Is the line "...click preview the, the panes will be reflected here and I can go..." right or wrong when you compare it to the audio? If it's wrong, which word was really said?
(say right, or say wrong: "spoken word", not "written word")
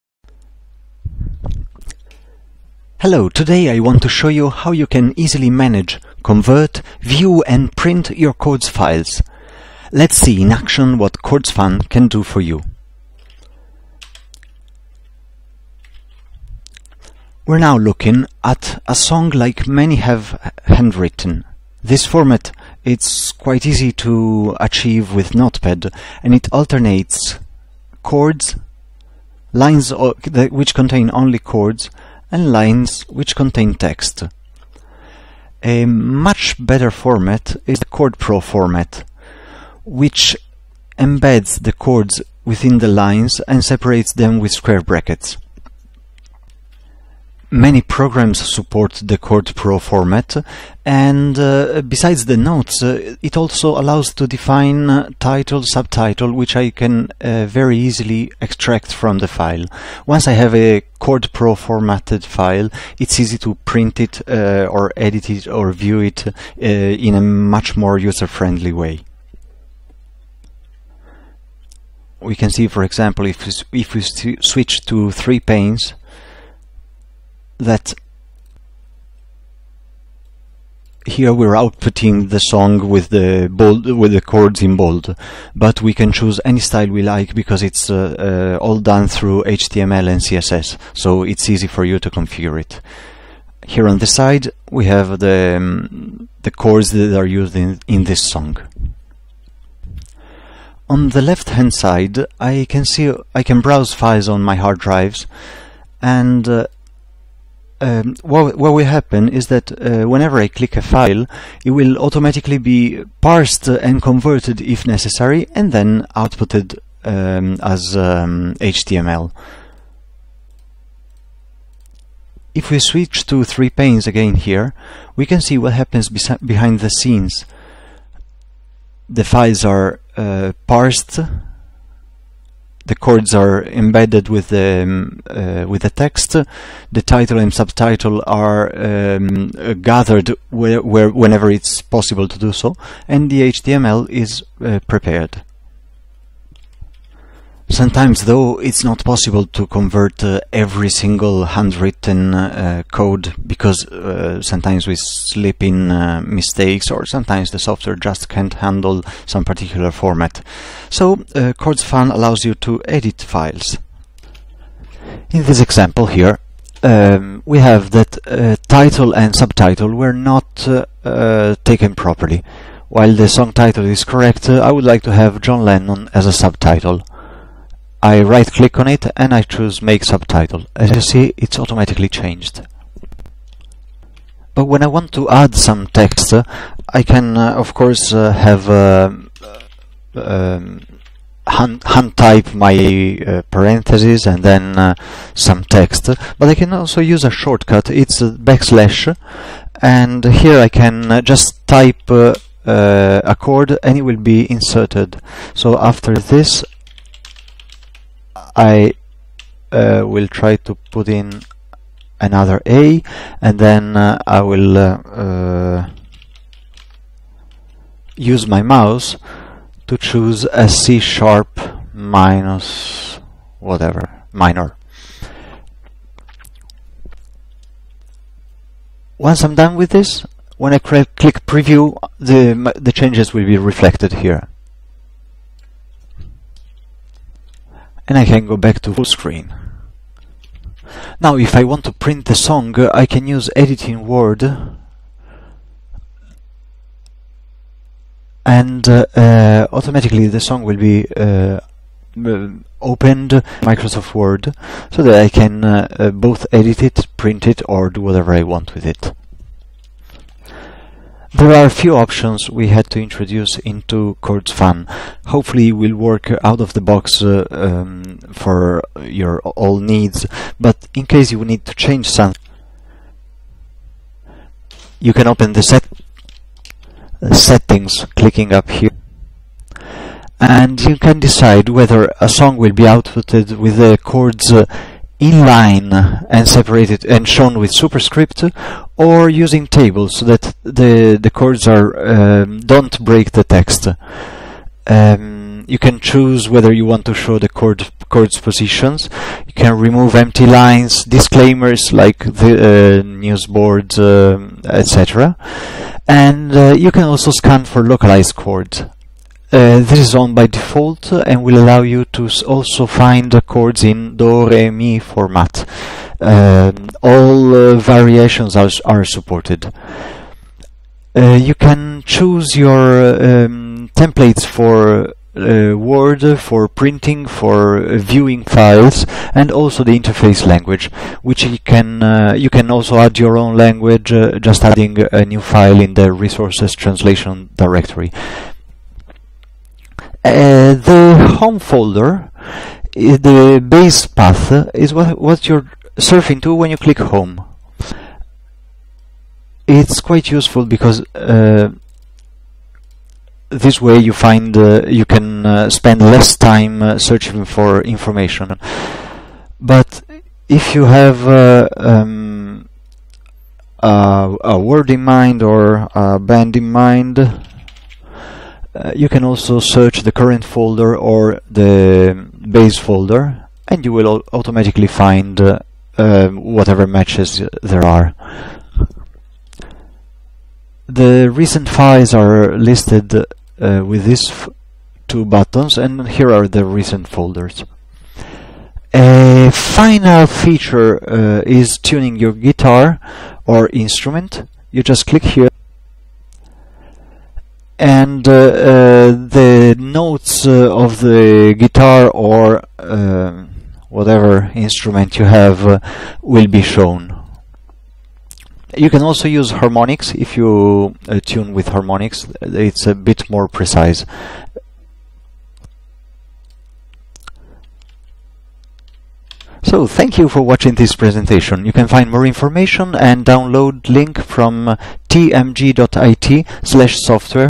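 wrong: "changes", not "panes".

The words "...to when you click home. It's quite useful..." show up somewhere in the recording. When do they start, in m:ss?
5:46.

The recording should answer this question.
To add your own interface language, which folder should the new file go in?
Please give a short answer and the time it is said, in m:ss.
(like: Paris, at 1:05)
Resources translation directory, at 5:36.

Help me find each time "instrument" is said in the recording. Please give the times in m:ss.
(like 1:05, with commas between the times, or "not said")
6:33, 6:44.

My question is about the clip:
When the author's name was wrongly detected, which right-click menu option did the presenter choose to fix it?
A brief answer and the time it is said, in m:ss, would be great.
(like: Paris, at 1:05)
Make subtitle, at 2:59.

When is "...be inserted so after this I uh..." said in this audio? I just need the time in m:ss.
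3:24.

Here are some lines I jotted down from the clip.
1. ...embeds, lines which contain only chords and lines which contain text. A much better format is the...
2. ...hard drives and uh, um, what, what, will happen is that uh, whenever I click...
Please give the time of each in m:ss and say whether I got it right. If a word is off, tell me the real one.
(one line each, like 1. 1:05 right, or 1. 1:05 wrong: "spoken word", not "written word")
1. 0:28 wrong: "chords", not "embeds"
2. 1:44 right.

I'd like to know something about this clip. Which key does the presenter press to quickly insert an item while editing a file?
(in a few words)
Backslash.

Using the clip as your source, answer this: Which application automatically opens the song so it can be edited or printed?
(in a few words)
Microsoft Word.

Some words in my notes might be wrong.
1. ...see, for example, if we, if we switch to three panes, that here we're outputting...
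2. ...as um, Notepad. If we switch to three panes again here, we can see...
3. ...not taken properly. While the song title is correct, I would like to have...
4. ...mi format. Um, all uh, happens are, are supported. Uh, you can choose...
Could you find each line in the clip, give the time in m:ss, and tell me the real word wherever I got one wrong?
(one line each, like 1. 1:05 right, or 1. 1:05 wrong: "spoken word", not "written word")
1. 1:12 right
2. 1:57 wrong: "HTML", not "Notepad"
3. 2:50 right
4. 5:14 wrong: "variations", not "happens".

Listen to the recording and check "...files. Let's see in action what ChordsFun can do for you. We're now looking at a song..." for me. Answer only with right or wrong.
right.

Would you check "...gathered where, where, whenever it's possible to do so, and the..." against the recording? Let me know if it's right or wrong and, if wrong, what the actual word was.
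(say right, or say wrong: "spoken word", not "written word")
right.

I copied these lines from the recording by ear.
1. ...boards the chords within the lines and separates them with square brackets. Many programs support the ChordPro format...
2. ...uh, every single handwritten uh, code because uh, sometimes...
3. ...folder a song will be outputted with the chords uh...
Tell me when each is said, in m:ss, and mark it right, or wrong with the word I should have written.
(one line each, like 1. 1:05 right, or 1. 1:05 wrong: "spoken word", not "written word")
1. 0:40 wrong: "embeds", not "boards"
2. 2:30 right
3. 4:41 wrong: "whether", not "folder".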